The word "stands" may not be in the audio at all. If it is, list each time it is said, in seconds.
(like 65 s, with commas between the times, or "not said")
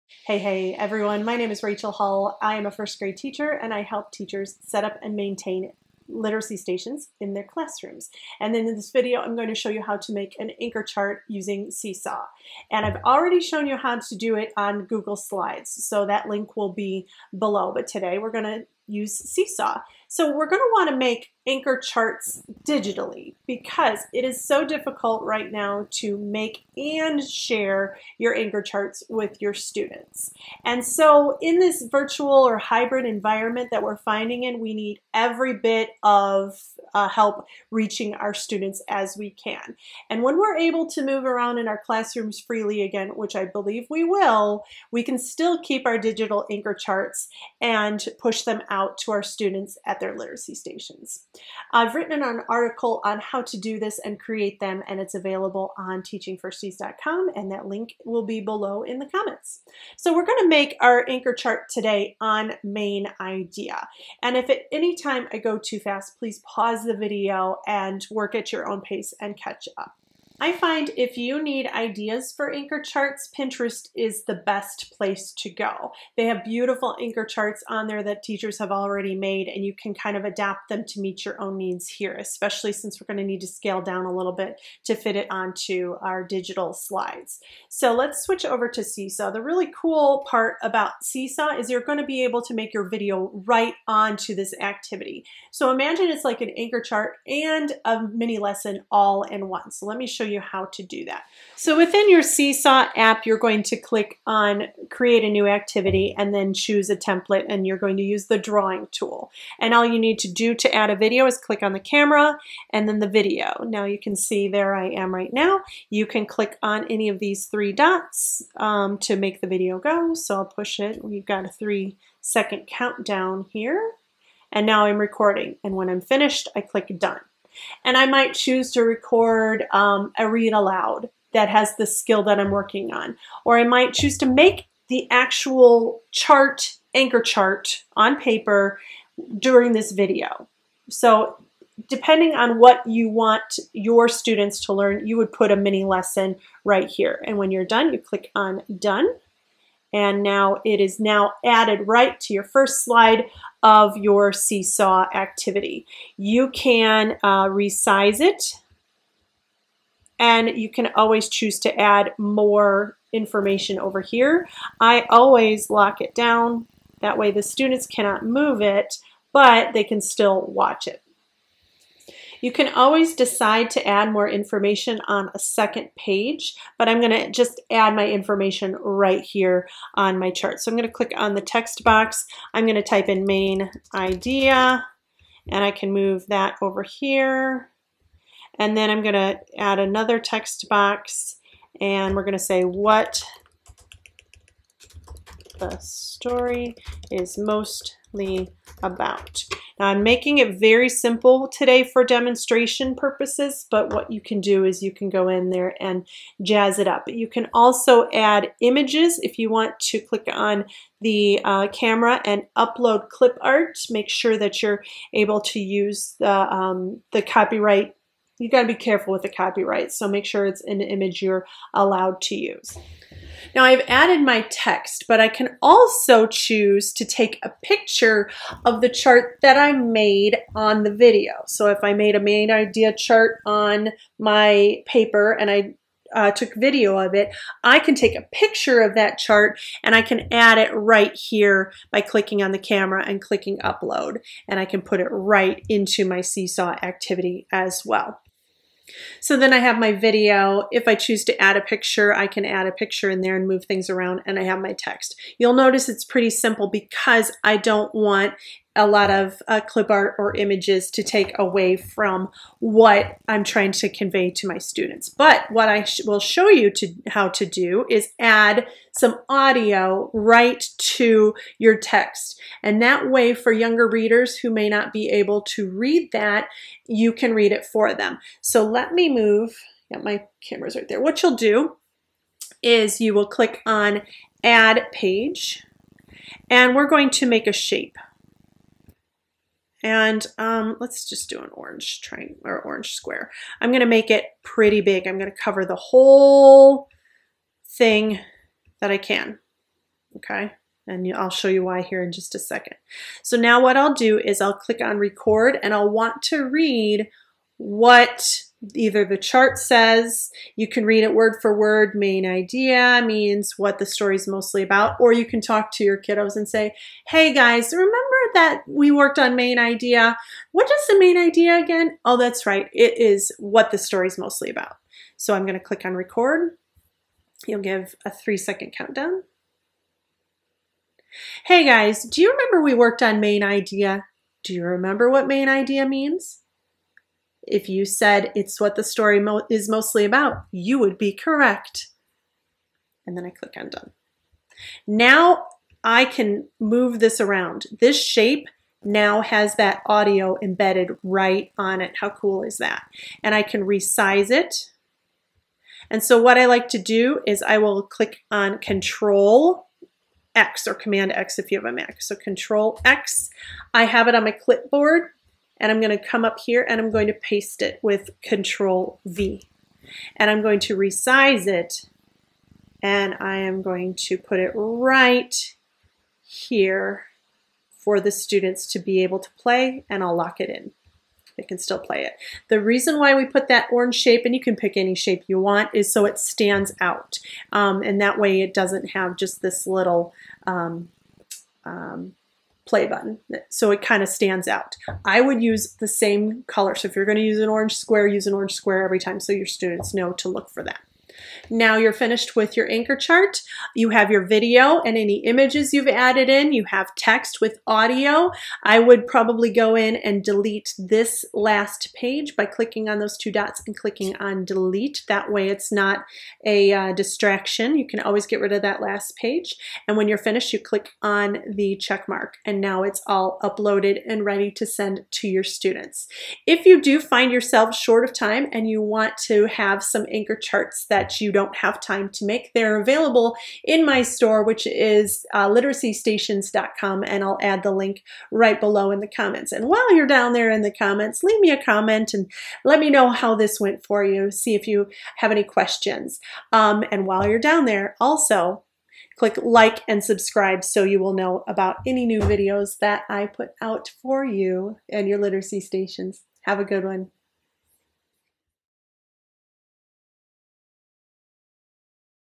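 386 s, 394 s.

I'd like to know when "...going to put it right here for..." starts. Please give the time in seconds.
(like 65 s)
373 s.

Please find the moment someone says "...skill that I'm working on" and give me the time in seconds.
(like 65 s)
131 s.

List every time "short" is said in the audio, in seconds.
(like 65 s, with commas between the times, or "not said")
427 s.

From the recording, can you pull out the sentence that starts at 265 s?
But what I sh will show you to how to do is add some audio right to your text.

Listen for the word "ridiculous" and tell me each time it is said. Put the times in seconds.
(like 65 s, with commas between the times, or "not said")
not said.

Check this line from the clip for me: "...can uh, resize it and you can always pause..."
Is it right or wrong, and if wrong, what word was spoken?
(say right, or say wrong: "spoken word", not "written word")
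wrong: "choose", not "pause".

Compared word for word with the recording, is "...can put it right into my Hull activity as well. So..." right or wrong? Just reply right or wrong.
wrong.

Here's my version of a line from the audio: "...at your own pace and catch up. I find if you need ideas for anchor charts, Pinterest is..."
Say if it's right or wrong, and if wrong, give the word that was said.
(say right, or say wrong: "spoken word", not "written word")
right.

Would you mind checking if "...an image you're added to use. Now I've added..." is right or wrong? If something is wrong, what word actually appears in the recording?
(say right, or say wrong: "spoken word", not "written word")
wrong: "allowed", not "added".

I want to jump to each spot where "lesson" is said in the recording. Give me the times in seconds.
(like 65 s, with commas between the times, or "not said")
98 s, 145 s.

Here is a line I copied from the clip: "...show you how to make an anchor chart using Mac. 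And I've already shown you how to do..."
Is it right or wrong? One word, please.
wrong.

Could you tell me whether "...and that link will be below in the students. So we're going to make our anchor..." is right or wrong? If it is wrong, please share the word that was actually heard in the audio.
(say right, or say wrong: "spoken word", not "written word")
wrong: "comments", not "students".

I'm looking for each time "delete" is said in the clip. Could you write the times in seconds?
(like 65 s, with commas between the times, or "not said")
410 s, 414 s.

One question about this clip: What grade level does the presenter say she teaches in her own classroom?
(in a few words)
First grade.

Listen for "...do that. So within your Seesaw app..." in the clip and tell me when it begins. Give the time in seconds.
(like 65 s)
100 s.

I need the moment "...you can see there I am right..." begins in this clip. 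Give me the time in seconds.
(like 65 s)
113 s.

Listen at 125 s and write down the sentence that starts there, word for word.
And when I'm finished, I click done.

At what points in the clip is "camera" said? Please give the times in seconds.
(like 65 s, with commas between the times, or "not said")
111 s, 211 s, 242 s, 280 s.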